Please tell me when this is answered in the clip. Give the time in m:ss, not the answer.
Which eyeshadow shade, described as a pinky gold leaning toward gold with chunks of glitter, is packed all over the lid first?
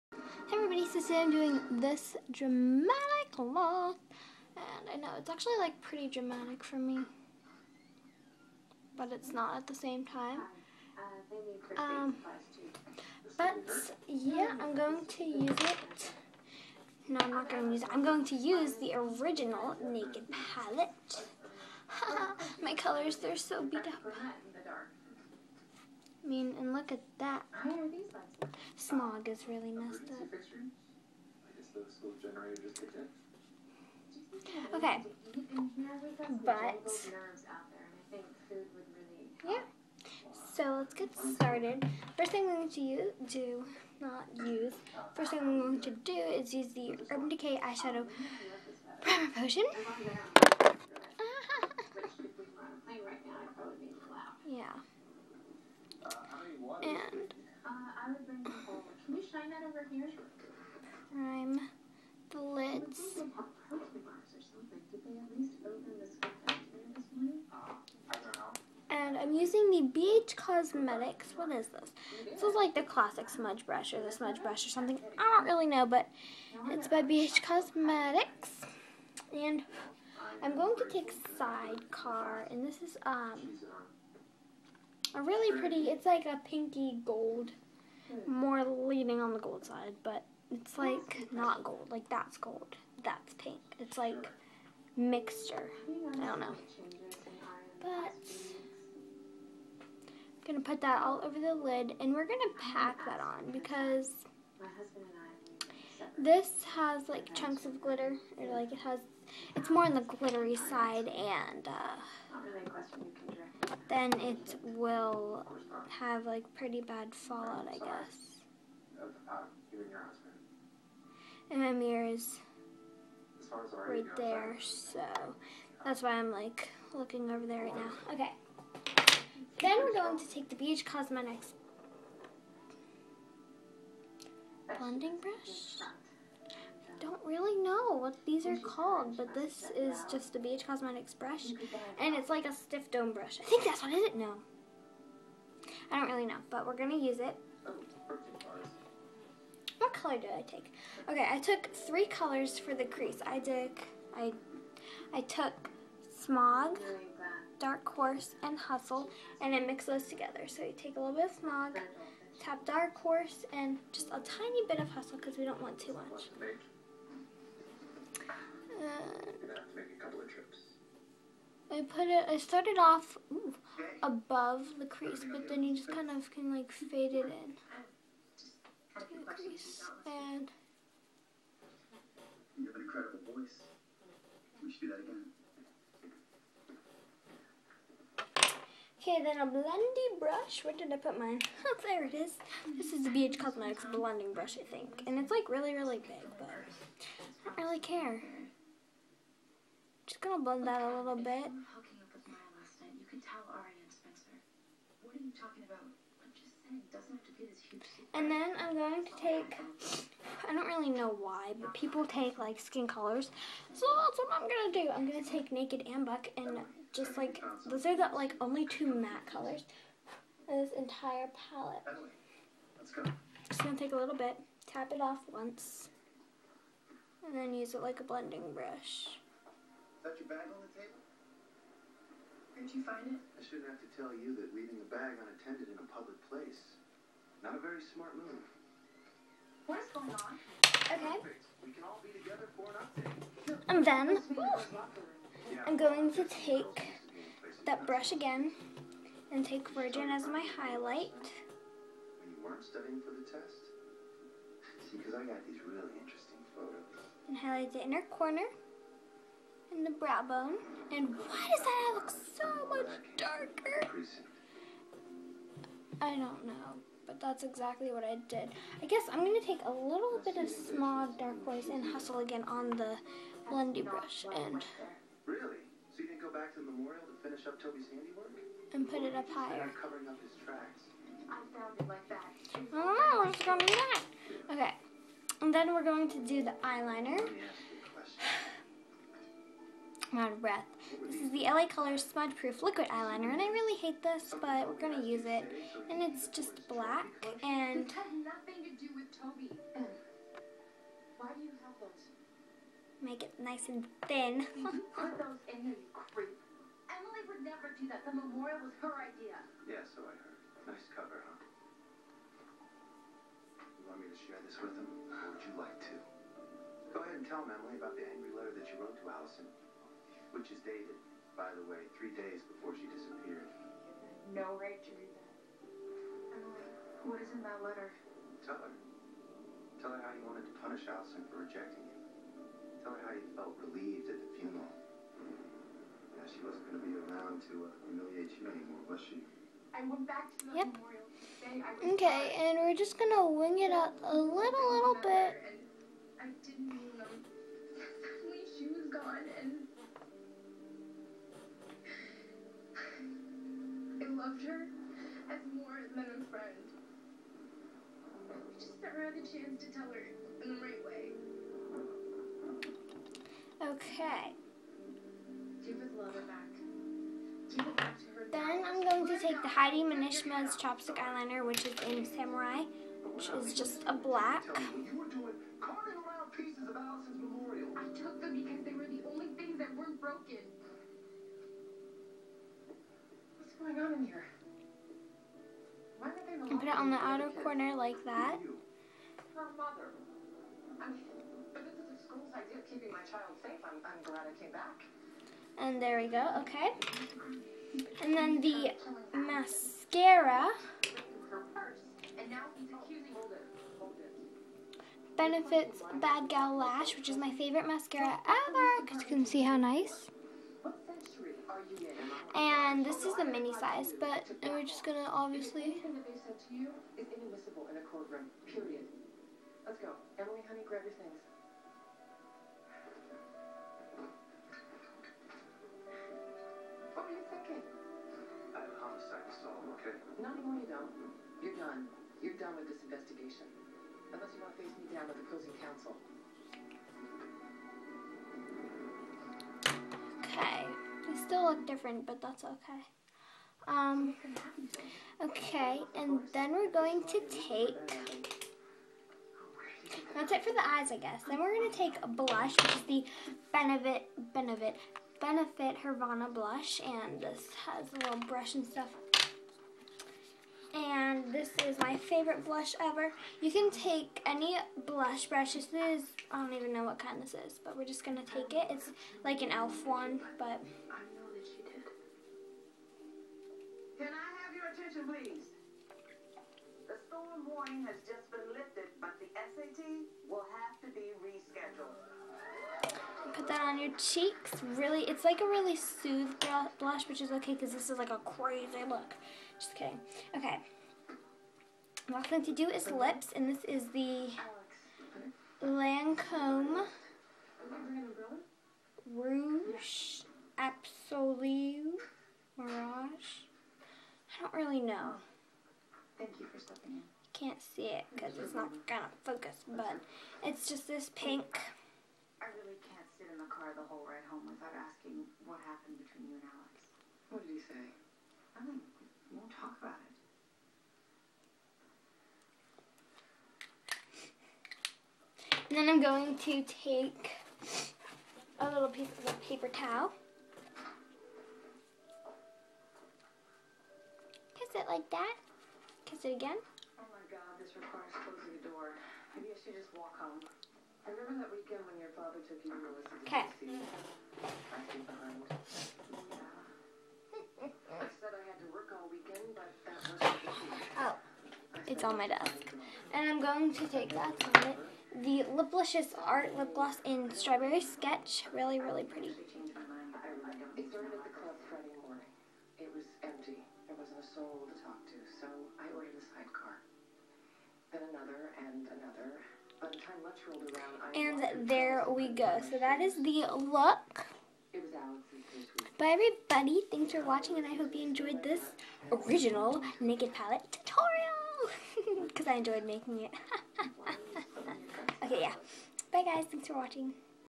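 1:21.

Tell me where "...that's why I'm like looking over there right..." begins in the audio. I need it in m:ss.
2:05.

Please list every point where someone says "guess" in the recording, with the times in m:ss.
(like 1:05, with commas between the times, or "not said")
1:57, 4:28, 7:30.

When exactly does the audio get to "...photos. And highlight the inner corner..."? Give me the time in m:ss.
4:16.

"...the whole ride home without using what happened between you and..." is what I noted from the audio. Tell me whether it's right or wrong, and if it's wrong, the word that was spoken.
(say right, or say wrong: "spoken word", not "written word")
wrong: "asking", not "using".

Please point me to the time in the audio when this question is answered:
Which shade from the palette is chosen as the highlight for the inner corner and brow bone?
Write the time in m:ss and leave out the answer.
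4:09.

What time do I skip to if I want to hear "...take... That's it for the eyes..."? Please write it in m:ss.
7:27.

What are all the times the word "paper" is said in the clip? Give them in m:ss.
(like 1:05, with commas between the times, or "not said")
8:49.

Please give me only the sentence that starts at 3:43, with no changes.
Just gonna take a little bit, tap it off once, and then use it like a blending brush.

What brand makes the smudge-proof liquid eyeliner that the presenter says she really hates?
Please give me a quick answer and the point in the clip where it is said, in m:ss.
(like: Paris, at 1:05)
LA Colors, at 4:51.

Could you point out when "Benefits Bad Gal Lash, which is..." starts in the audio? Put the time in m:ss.
6:45.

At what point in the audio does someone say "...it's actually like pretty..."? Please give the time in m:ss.
0:05.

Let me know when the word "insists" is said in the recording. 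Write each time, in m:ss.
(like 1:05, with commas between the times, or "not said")
not said.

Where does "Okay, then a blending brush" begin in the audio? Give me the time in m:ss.
3:09.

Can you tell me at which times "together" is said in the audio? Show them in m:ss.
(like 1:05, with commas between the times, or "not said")
2:40, 4:02.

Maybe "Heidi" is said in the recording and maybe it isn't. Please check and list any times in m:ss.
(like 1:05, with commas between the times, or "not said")
6:09.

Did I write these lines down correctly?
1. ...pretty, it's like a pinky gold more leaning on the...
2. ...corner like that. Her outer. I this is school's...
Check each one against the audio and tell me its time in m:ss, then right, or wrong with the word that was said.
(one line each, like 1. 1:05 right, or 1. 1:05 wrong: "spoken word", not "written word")
1. 1:25 right
2. 6:27 wrong: "mother", not "outer".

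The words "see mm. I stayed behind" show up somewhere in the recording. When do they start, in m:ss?
9:03.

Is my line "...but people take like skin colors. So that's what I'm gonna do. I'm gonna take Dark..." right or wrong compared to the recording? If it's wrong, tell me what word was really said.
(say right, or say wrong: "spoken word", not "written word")
wrong: "Naked", not "Dark".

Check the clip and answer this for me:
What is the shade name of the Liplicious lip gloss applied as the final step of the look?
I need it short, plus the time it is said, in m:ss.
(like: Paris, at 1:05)
Strawberry Sketch, at 9:17.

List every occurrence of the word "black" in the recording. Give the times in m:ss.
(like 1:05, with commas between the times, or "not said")
4:56, 6:13.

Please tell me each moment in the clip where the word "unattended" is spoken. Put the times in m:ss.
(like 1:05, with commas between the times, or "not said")
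3:55.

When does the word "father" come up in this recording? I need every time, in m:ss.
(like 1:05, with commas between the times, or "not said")
9:02.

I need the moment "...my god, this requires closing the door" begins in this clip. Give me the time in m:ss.
8:57.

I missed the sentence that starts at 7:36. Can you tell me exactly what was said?
And this has a little brush and stuff.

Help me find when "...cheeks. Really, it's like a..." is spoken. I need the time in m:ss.
8:03.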